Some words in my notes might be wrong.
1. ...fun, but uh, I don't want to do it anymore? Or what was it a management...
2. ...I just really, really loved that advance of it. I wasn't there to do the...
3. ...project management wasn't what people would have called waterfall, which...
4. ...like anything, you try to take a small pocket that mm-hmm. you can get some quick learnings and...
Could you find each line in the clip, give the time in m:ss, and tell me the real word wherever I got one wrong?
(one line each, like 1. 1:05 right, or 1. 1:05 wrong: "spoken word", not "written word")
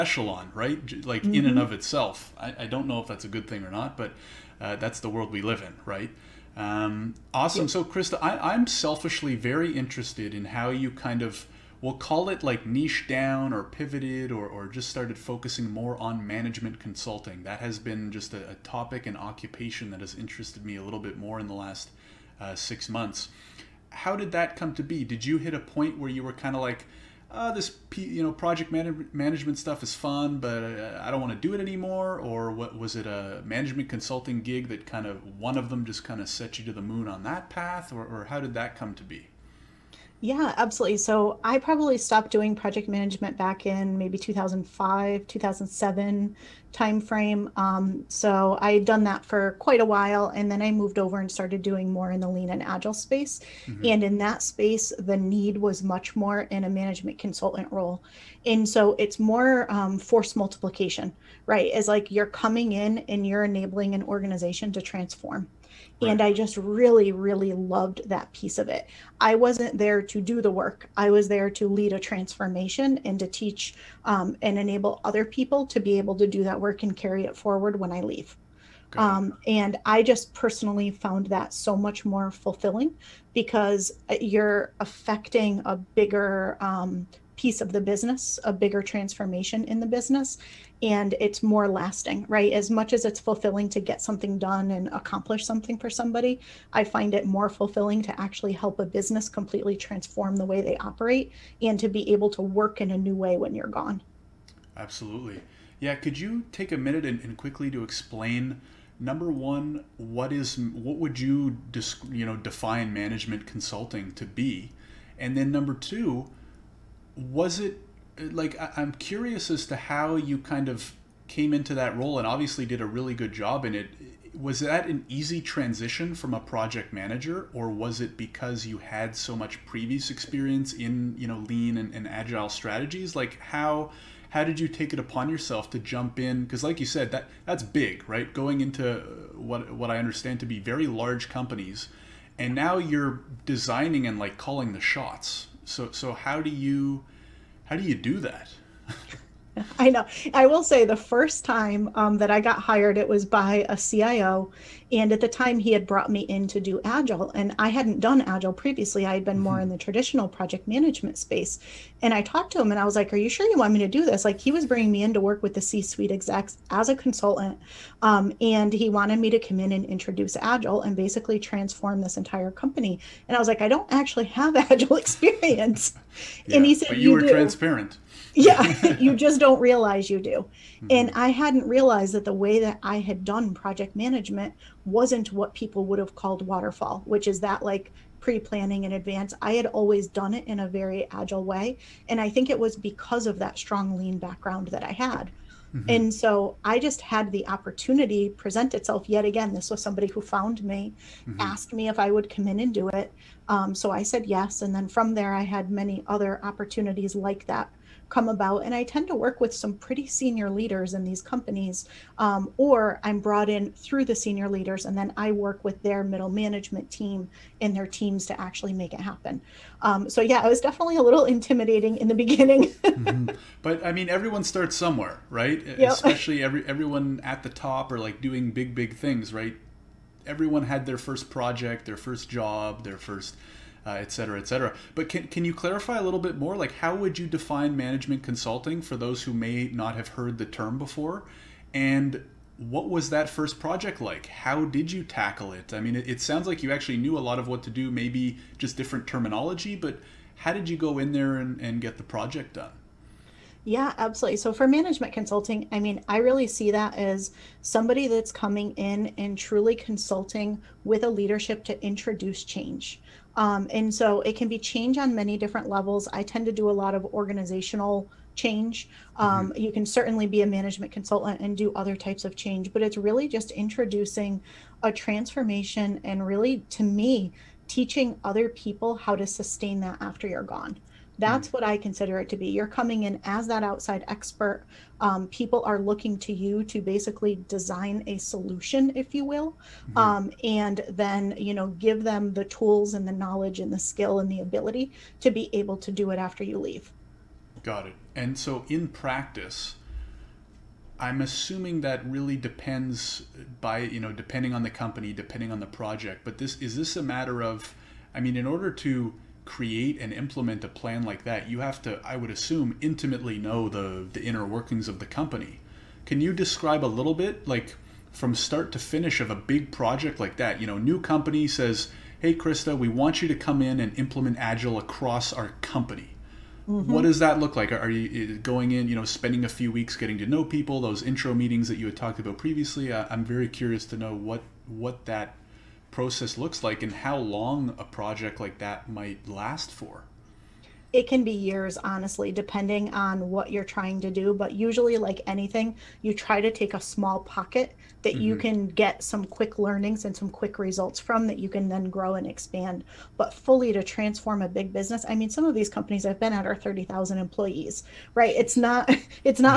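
1. 0:29 right
2. 1:06 wrong: "piece", not "advance"
3. 3:03 right
4. 5:44 right.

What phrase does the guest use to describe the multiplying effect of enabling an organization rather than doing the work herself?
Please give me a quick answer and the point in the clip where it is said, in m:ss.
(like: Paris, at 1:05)
Force multiplication, at 0:59.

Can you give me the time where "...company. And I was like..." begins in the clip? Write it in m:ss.
2:52.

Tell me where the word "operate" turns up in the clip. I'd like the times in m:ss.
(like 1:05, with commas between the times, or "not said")
1:40.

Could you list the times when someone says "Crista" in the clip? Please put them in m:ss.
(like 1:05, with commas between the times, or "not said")
0:07, 5:22.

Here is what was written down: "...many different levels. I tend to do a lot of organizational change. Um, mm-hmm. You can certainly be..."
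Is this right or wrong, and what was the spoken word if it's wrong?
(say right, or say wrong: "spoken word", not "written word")
right.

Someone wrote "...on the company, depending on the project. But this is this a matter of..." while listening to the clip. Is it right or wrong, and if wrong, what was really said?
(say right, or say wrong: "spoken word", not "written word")
right.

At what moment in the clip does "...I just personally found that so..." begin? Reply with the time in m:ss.
1:19.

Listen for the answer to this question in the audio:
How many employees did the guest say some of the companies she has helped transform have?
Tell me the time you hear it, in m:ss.
5:56.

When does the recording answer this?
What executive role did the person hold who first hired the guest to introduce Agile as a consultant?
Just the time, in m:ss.
2:33.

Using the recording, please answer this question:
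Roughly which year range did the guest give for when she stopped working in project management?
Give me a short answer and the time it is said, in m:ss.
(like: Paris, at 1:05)
2005 to 2007, at 0:44.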